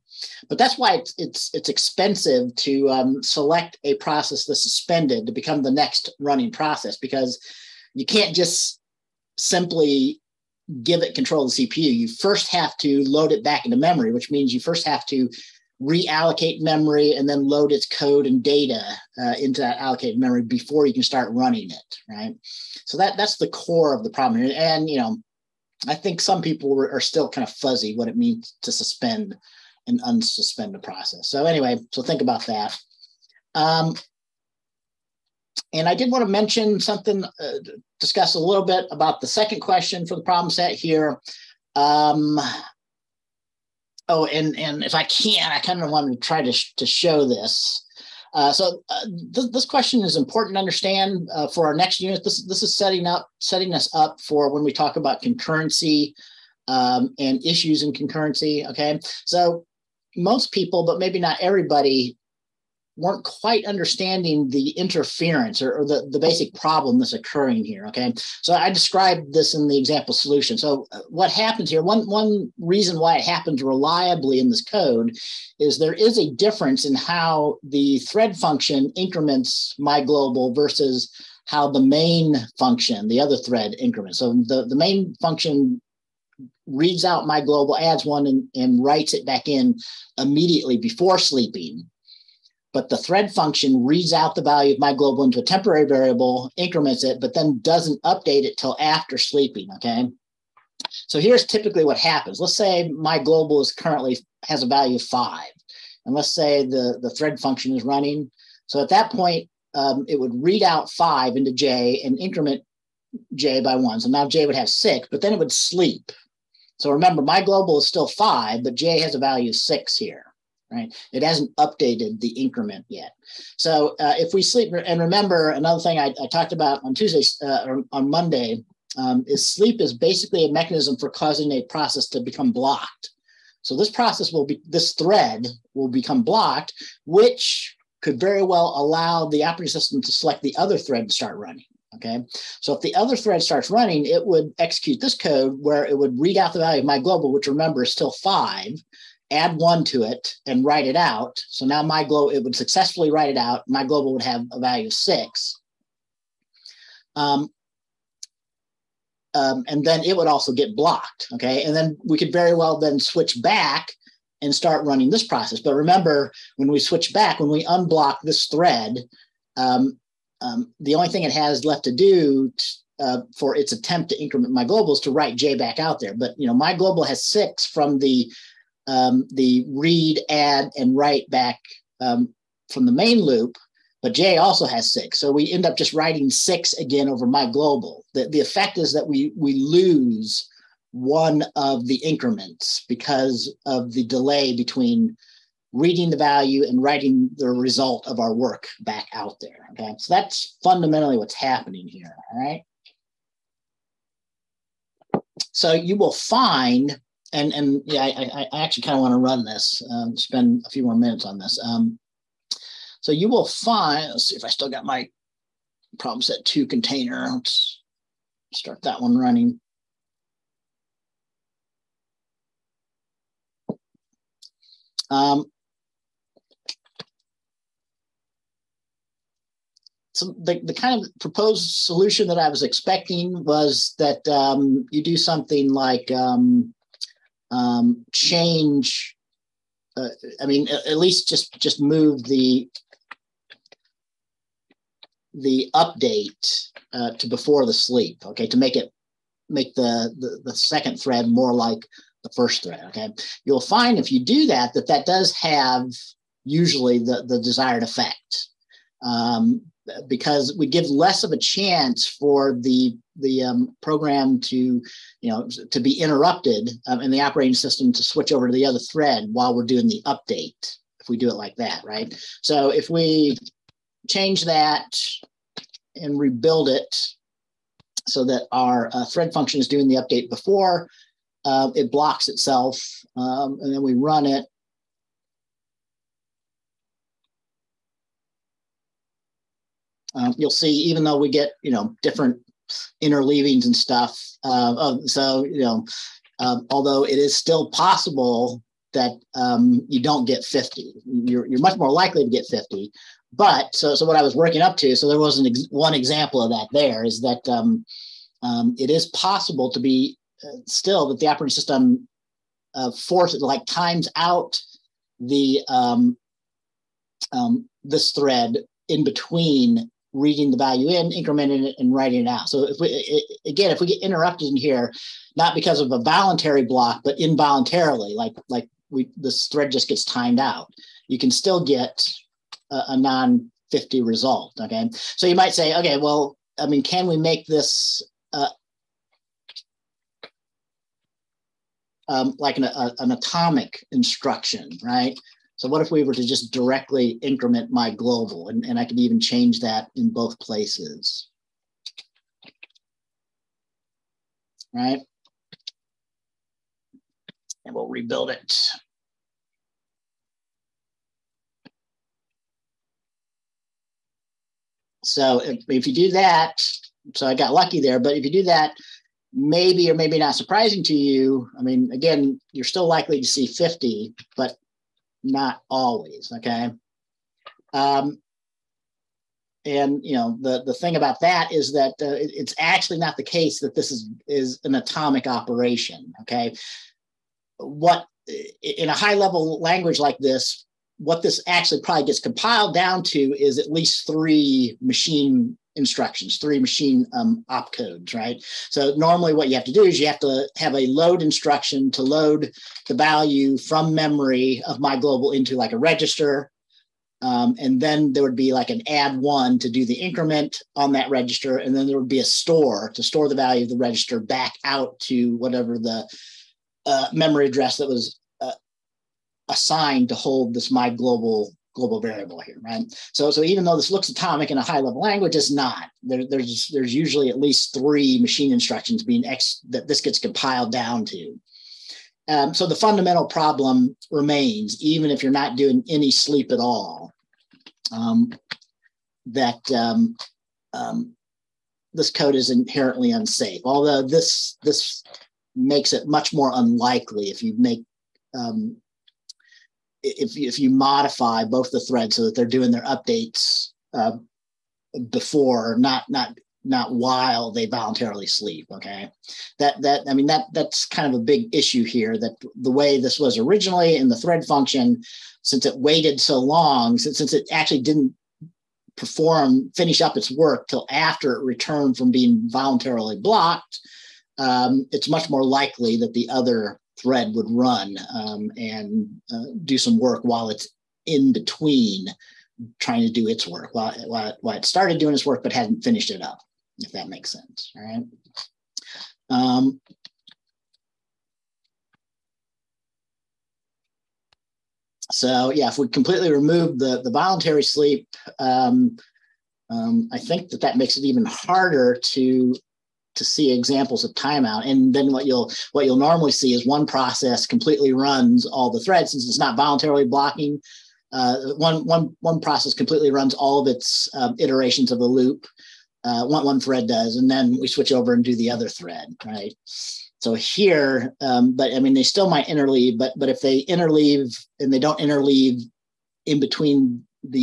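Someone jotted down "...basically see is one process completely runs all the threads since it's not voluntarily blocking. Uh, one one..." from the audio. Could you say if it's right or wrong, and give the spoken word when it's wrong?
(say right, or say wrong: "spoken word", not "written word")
wrong: "normally", not "basically".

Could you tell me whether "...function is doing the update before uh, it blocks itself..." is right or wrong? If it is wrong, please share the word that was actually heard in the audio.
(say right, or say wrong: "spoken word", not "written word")
right.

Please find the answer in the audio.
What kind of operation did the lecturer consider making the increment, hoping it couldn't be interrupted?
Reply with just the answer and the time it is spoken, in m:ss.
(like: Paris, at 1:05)
atomic instruction, at 5:43.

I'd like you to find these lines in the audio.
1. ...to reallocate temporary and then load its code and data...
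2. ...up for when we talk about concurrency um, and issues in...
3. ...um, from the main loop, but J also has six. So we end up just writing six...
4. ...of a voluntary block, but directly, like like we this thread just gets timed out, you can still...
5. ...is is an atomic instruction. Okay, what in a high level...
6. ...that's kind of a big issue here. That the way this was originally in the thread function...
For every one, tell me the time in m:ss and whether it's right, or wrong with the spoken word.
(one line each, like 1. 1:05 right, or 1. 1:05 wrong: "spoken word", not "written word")
1. 0:15 wrong: "memory", not "temporary"
2. 0:53 right
3. 3:02 right
4. 5:25 wrong: "involuntarily", not "directly"
5. 6:23 wrong: "operation", not "instruction"
6. 7:40 right.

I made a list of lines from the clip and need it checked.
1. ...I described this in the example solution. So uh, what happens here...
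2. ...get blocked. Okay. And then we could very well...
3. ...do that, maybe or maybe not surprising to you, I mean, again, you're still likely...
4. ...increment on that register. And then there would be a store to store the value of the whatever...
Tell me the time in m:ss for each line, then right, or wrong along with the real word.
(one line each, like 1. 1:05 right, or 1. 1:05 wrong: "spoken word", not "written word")
1. 1:08 right
2. 2:40 right
3. 6:08 right
4. 6:49 wrong: "register", not "whatever".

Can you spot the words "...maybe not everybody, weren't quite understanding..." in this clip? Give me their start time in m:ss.
1:00.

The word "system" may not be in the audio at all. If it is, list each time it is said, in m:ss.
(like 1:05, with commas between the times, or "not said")
2:19, 4:27, 5:11.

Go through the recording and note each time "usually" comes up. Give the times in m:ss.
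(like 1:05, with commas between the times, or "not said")
4:16, 7:06.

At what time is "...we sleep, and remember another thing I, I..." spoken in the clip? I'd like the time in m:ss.
2:04.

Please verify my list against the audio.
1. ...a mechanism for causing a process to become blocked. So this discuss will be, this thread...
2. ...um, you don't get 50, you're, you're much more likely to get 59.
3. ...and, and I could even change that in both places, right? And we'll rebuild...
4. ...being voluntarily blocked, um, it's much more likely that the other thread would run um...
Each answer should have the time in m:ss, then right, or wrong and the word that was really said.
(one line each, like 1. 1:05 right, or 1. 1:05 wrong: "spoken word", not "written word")
1. 2:10 wrong: "process", not "discuss"
2. 4:59 wrong: "50", not "59"
3. 5:48 right
4. 7:52 right.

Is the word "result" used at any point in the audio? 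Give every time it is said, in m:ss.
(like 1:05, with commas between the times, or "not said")
3:17, 5:34.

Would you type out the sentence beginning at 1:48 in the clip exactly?
So at that point, um, it would read out five into J and increment J by one.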